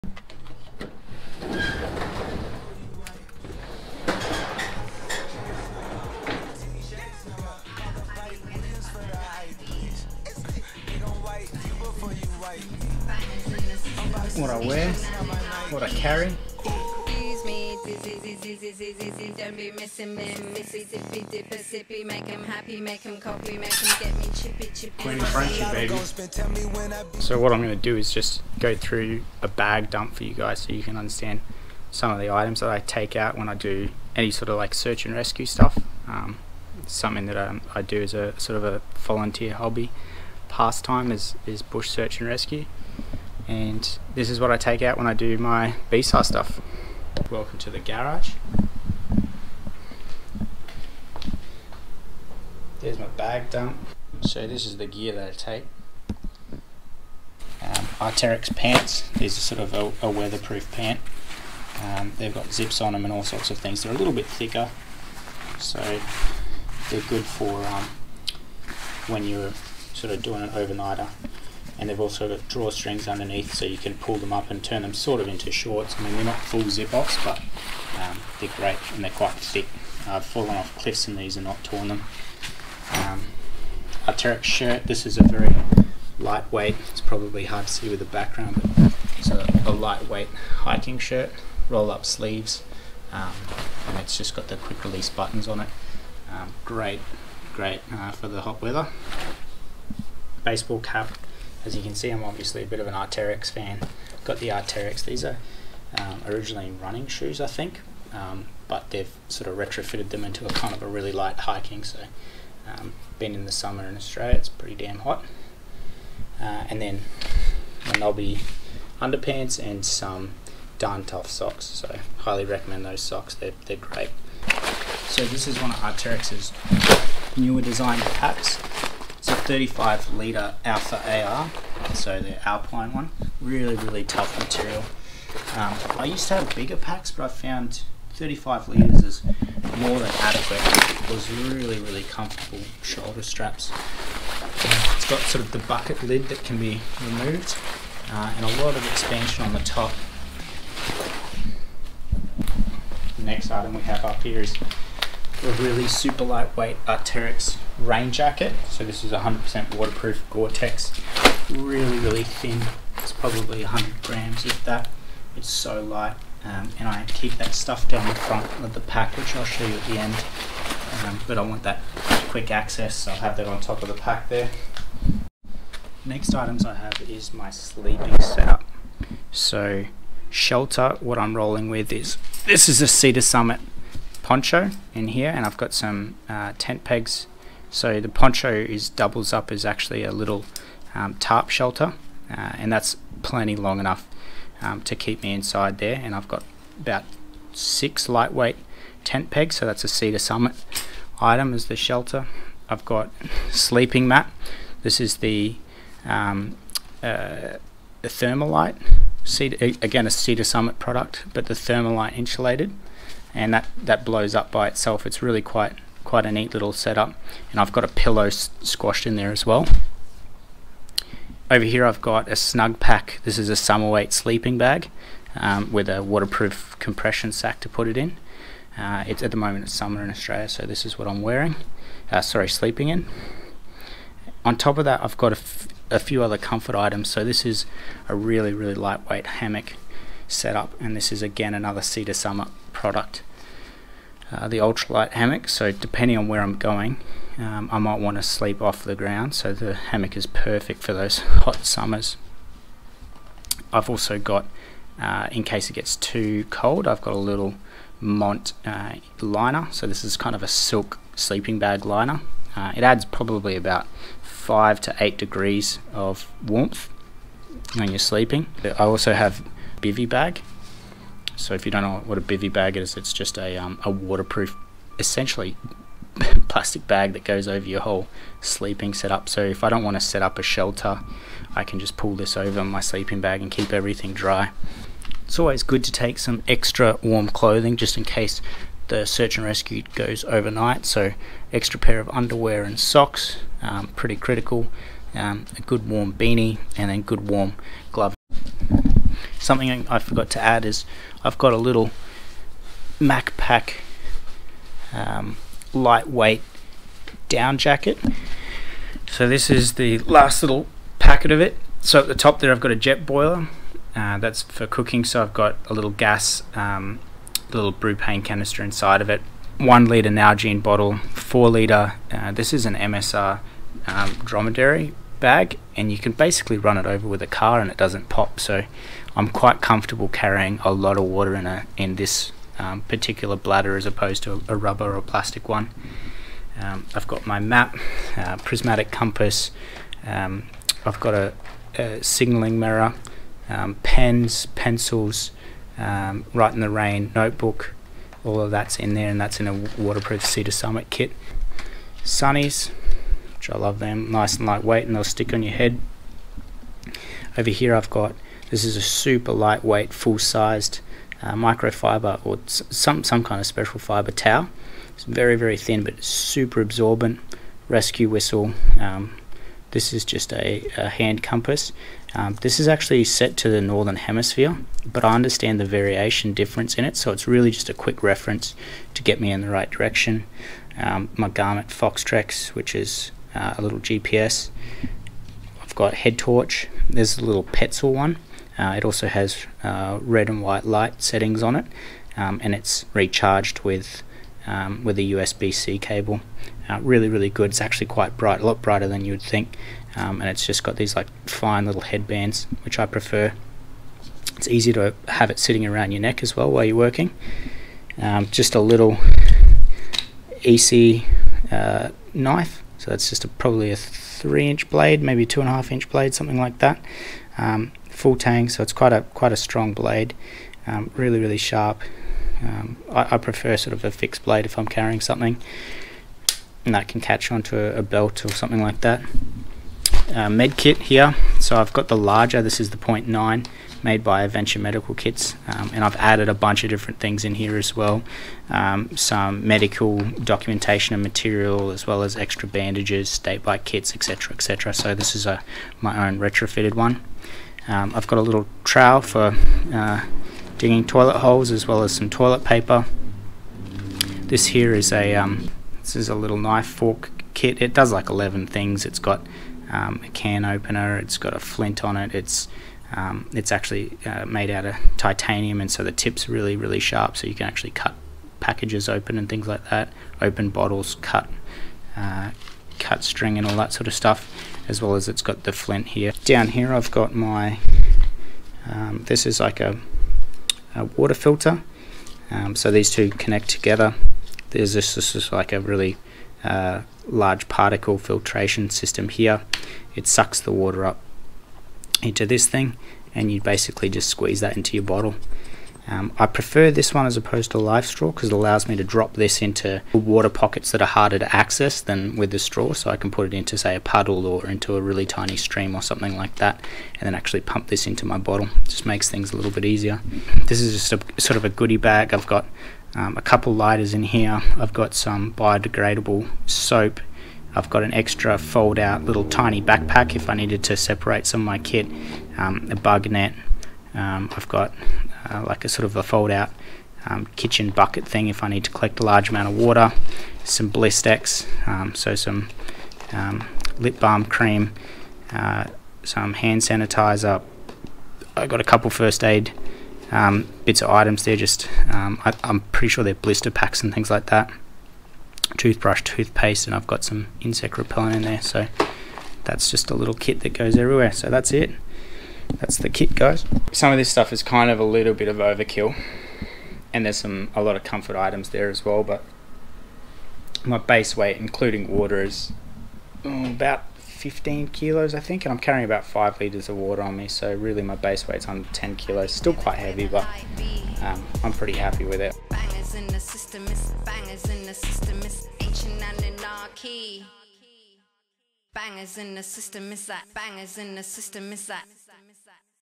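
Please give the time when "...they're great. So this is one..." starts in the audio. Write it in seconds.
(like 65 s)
123 s.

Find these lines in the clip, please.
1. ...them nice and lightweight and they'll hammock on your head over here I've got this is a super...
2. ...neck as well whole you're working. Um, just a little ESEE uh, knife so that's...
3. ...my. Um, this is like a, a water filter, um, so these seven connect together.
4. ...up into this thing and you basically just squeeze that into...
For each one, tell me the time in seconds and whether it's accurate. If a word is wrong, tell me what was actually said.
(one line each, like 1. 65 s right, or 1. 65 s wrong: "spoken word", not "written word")
1. 353 s wrong: "stick", not "hammock"
2. 406 s wrong: "while", not "whole"
3. 477 s wrong: "two", not "seven"
4. 490 s right.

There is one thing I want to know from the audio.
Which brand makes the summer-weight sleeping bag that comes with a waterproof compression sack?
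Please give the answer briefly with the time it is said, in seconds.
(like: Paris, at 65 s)
Snugpak, at 222 s.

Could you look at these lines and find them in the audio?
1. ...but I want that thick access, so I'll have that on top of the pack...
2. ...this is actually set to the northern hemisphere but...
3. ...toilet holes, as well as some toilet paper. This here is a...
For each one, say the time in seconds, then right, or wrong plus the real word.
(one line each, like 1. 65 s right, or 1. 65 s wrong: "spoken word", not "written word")
1. 171 s wrong: "quick", not "thick"
2. 372 s right
3. 450 s right.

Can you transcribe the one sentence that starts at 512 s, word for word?
I've got um, a couple lighters in here.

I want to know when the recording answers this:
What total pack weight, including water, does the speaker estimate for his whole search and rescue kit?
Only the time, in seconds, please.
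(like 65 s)
563 s.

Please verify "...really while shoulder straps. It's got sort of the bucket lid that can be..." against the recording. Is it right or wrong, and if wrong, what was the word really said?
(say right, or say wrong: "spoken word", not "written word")
wrong: "comfortable", not "while".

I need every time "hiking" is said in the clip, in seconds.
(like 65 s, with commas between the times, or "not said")
90 s, 111 s.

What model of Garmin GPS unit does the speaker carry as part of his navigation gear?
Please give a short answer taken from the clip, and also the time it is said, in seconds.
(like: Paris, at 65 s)
Garmin Foretrex, at 381 s.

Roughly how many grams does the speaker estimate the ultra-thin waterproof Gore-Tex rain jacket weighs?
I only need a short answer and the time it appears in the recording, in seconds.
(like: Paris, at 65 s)
100 grams, at 163 s.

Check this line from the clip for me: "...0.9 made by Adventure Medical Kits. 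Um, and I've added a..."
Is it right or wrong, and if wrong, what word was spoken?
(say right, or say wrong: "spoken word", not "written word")
right.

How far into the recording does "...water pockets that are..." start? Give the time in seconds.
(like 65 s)
499 s.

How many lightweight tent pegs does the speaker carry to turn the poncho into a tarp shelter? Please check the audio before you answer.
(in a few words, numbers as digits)
6.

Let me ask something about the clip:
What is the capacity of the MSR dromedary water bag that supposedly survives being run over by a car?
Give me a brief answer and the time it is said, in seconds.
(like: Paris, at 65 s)
4 litres, at 321 s.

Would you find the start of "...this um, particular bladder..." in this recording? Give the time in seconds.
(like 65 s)
331 s.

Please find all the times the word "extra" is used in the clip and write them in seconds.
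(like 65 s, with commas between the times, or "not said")
286 s, 291 s, 442 s, 517 s.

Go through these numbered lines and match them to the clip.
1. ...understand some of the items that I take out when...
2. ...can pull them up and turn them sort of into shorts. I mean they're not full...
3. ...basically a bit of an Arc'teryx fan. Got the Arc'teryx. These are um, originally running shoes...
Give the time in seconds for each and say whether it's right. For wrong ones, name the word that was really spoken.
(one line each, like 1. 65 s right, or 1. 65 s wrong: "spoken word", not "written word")
1. 30 s right
2. 73 s right
3. 102 s wrong: "obviously", not "basically".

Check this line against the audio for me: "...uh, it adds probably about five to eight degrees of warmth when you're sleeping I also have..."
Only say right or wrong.
right.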